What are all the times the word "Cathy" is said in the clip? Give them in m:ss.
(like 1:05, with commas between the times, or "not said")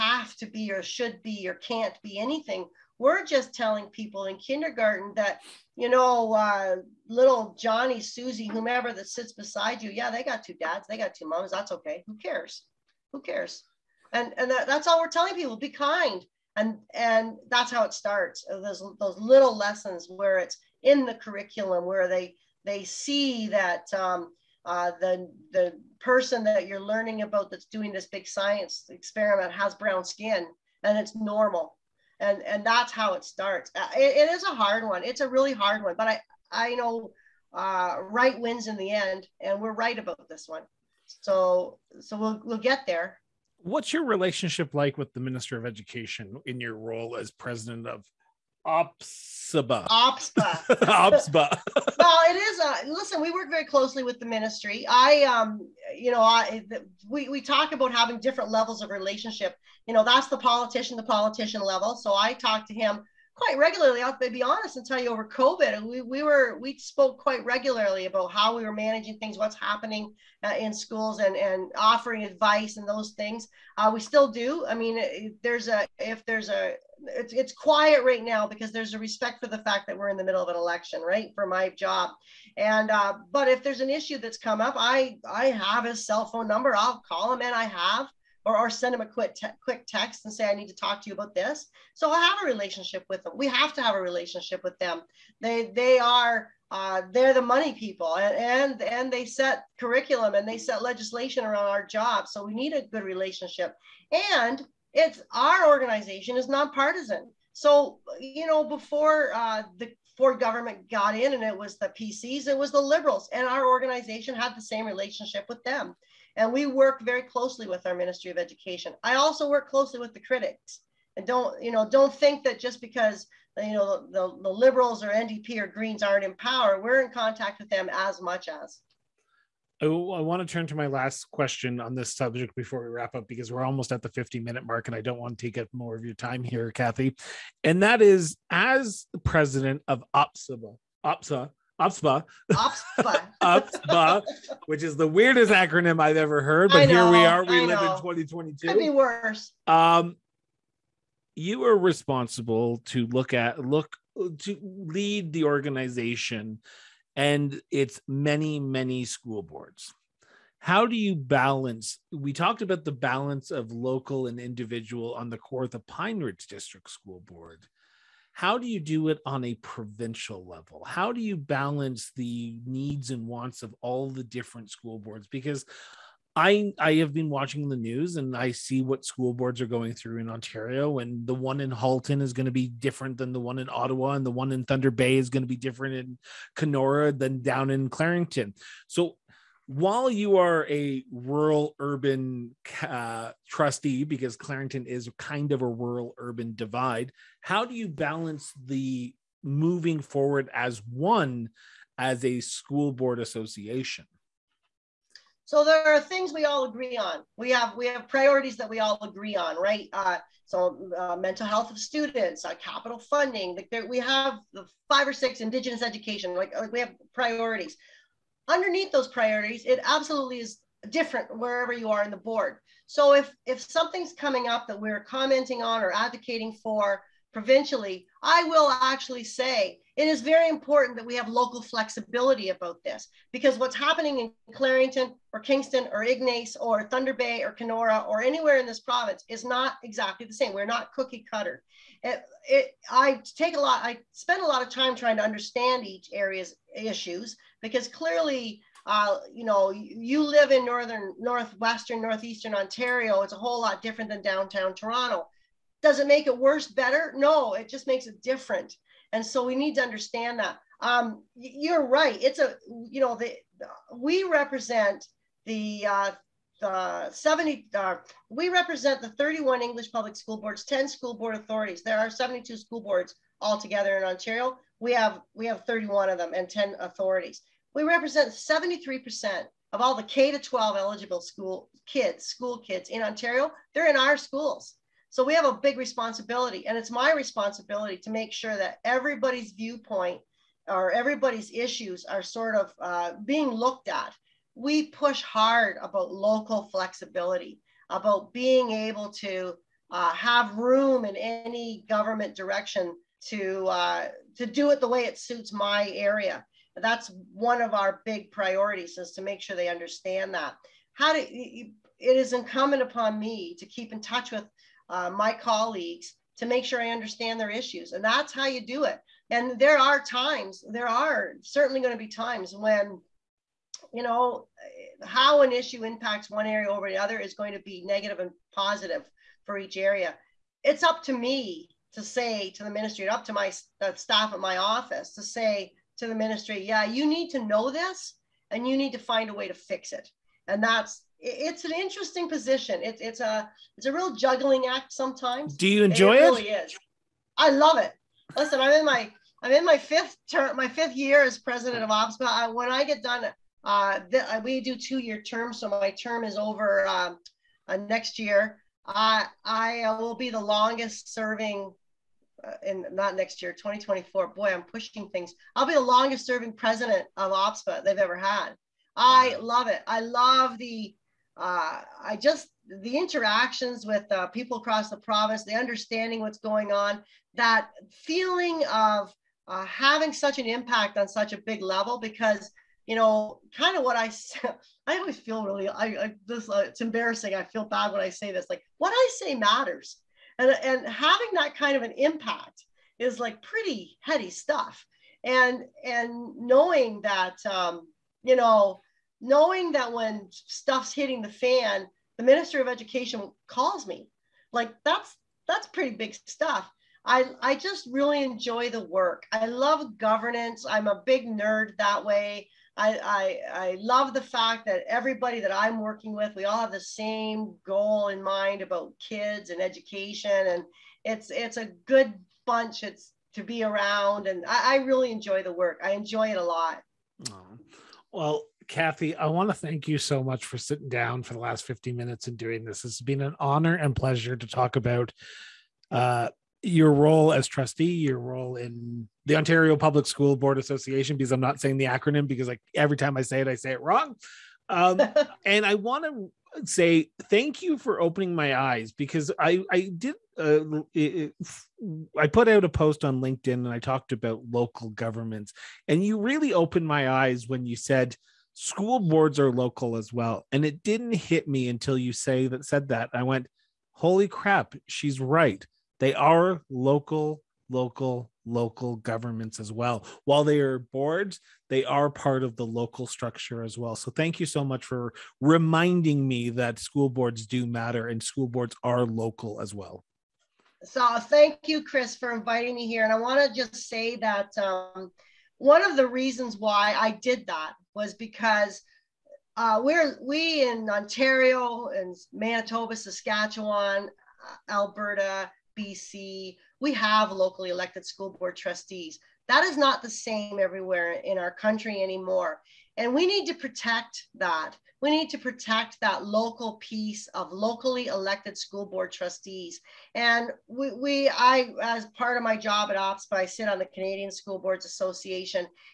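2:16, 7:08.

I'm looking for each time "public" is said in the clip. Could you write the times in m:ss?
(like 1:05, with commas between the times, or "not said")
4:29, 7:19.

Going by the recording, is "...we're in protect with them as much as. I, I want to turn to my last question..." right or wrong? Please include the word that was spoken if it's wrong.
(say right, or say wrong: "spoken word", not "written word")
wrong: "contact", not "protect".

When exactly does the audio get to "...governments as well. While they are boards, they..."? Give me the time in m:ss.
7:48.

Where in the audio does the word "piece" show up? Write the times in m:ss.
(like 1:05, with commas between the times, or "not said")
8:26.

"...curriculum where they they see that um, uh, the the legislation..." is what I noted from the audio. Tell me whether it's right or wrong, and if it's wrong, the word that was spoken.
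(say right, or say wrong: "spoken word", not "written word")
wrong: "person", not "legislation".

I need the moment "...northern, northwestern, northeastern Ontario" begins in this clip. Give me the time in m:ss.
4:10.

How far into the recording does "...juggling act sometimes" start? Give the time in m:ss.
5:44.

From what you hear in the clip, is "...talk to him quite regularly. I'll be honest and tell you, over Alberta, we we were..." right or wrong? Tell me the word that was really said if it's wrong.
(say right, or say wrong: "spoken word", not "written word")
wrong: "COVID", not "Alberta".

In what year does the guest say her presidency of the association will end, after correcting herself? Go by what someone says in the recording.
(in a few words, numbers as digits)
2024.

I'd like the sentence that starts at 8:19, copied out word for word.
That is not the same everywhere in our country anymore.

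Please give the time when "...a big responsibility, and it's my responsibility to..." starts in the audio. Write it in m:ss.
4:45.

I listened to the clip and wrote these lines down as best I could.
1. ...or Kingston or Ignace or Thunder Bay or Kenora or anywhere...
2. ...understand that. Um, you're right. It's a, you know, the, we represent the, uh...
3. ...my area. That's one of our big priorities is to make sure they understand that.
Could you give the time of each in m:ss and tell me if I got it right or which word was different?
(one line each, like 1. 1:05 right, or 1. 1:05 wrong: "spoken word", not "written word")
1. 3:55 right
2. 4:19 right
3. 5:05 right.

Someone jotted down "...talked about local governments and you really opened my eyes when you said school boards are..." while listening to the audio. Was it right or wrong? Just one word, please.
right.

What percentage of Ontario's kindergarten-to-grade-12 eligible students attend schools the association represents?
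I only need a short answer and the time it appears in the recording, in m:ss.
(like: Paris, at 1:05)
73%, at 4:38.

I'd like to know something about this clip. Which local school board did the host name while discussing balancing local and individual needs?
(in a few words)
Kawartha Pine Ridge District School Board.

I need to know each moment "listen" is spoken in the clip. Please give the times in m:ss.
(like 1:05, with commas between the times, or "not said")
0:52, 5:48.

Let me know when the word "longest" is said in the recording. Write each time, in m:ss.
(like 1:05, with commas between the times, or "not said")
6:00, 6:05.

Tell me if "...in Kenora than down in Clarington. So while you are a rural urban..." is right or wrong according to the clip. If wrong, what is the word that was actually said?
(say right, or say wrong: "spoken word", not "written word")
right.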